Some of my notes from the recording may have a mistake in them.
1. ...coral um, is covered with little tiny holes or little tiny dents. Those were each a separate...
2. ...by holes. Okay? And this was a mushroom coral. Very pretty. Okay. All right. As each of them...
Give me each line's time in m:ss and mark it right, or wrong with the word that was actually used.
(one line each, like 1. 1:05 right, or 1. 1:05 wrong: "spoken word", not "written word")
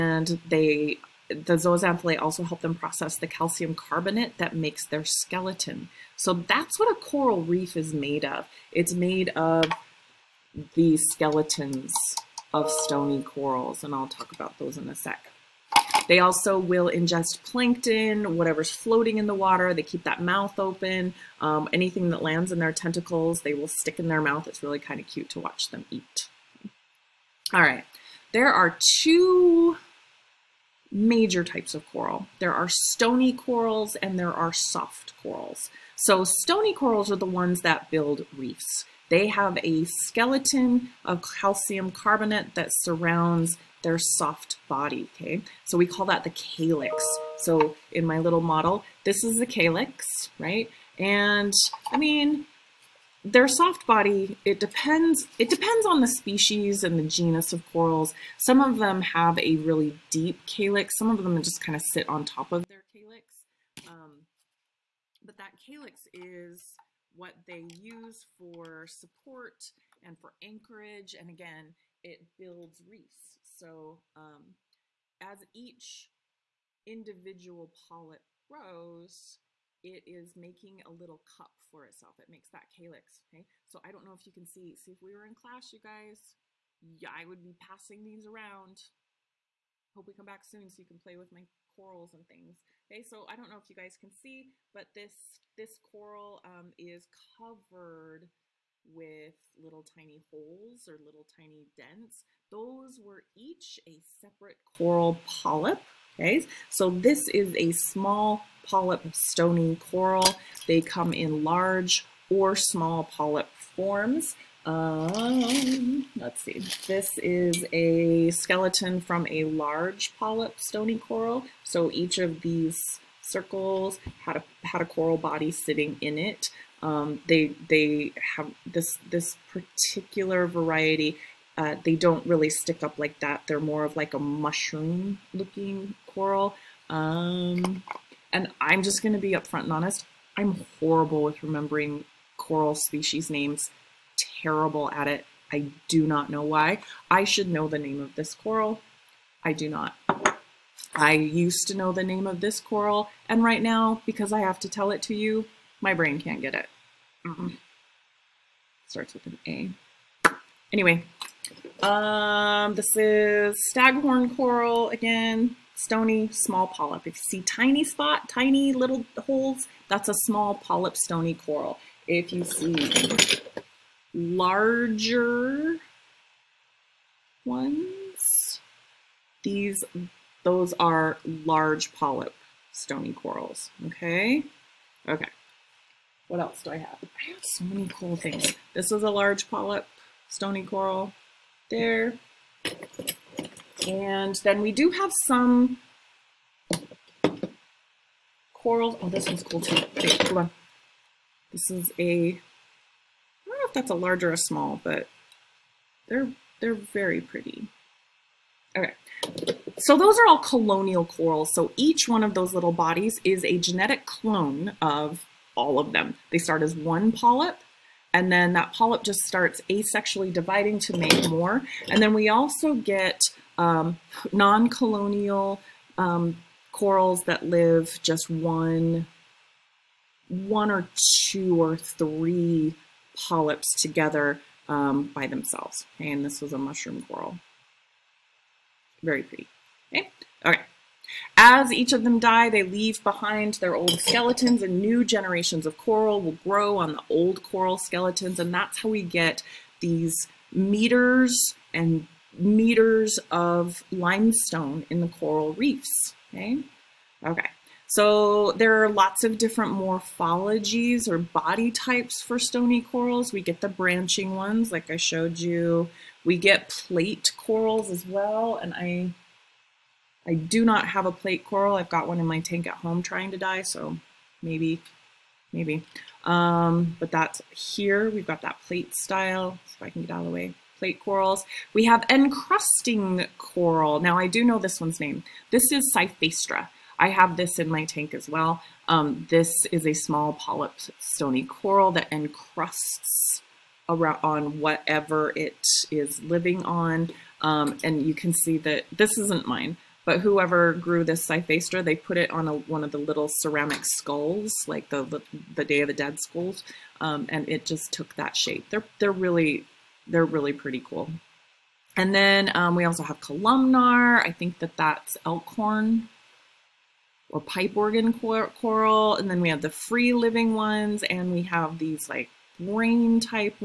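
1. 1:35 right
2. 3:55 wrong: "themselves", not "holes".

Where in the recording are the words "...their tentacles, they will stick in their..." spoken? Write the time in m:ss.
0:22.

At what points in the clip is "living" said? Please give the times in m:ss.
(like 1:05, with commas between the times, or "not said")
4:56, 5:20.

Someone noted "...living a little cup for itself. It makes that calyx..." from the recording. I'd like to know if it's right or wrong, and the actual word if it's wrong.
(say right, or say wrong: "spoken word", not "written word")
wrong: "making", not "living".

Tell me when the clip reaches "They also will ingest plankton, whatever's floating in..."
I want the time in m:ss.
0:16.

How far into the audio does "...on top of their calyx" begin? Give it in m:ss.
1:02.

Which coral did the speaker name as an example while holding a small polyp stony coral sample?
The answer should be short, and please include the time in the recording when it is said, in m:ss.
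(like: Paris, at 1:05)
staghorn coral, at 2:43.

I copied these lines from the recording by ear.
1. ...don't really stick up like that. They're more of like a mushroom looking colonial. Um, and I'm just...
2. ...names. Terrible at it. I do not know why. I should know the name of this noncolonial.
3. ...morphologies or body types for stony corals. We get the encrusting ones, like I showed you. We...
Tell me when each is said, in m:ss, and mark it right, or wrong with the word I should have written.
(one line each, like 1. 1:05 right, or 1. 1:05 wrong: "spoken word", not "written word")
1. 2:11 wrong: "coral", not "colonial"
2. 2:23 wrong: "coral", not "noncolonial"
3. 4:19 wrong: "branching", not "encrusting".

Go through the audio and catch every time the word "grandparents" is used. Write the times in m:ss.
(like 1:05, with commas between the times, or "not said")
not said.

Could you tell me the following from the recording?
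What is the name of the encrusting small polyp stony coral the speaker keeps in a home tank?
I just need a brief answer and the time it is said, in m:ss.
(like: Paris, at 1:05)
Cyphastrea, at 4:45.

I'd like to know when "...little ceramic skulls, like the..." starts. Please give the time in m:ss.
5:02.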